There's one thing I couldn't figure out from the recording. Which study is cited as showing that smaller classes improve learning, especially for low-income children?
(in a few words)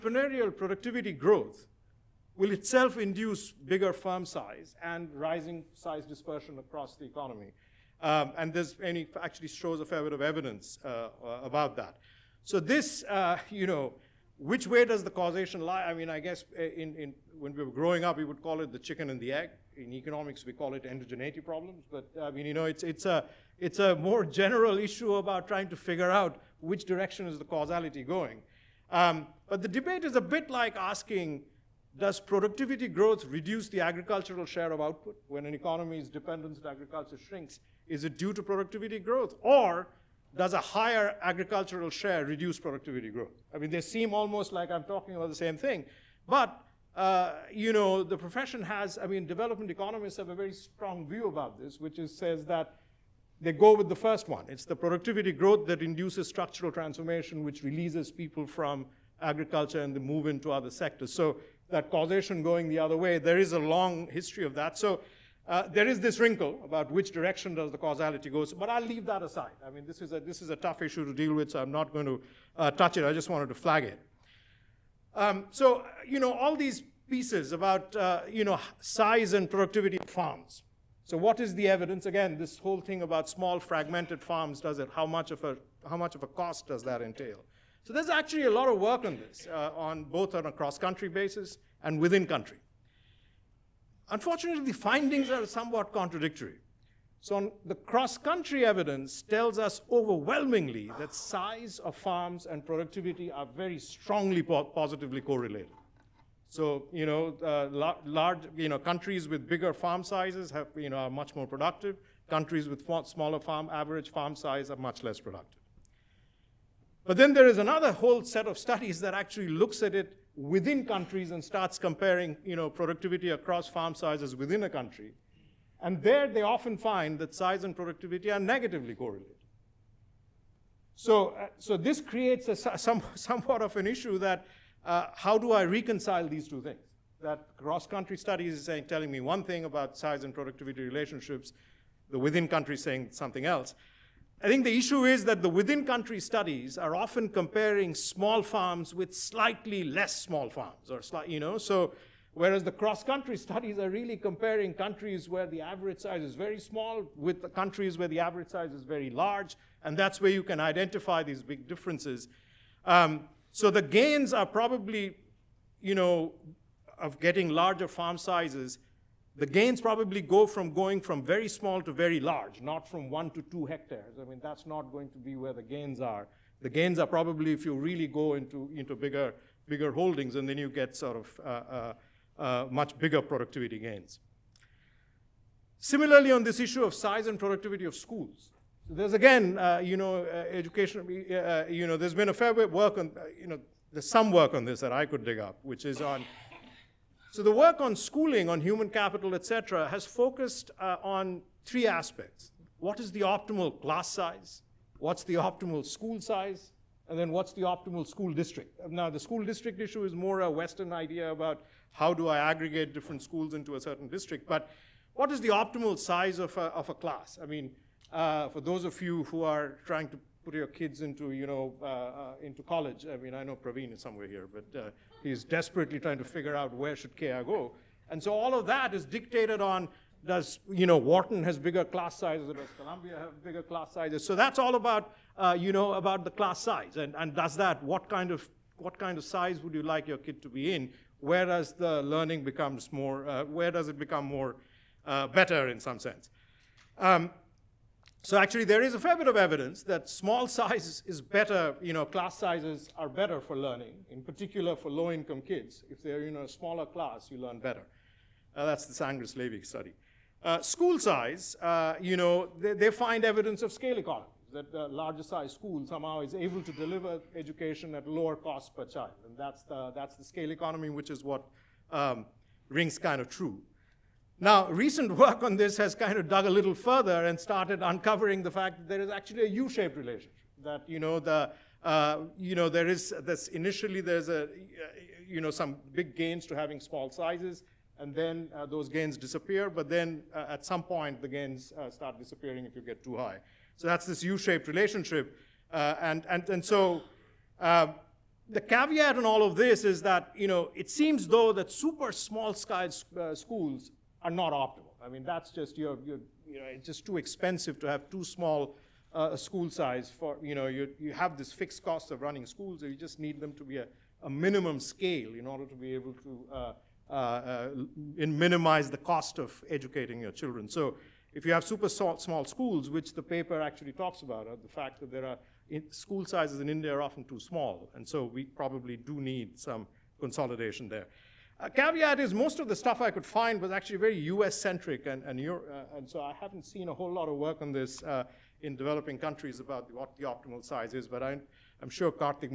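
Angrist-Lavy.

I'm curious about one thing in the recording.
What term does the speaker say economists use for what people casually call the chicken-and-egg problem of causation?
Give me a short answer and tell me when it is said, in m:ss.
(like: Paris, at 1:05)
Endogeneity problems, at 0:20.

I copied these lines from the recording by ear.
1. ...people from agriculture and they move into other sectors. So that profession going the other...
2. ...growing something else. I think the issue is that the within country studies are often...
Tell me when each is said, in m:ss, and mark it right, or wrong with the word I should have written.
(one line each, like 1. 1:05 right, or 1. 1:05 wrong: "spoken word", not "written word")
1. 0:58 wrong: "causation", not "profession"
2. 2:22 wrong: "saying", not "growing".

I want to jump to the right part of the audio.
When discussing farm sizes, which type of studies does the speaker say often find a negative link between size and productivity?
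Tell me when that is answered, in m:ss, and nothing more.
2:00.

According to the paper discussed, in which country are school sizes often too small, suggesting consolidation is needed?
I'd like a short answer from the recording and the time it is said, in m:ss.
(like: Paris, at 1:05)
India, at 5:26.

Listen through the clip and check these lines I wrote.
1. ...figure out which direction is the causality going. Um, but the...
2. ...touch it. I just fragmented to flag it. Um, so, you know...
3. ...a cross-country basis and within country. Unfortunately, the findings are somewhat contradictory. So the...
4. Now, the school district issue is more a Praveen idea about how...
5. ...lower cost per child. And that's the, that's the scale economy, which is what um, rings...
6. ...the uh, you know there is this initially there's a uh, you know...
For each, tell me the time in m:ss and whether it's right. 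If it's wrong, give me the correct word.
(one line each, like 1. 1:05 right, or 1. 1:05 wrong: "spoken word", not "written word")
1. 0:25 right
2. 1:12 wrong: "wanted", not "fragmented"
3. 1:30 right
4. 3:28 wrong: "Western", not "Praveen"
5. 4:28 right
6. 4:41 right.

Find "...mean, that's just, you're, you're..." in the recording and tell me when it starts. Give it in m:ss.
5:05.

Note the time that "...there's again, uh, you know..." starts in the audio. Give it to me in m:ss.
3:08.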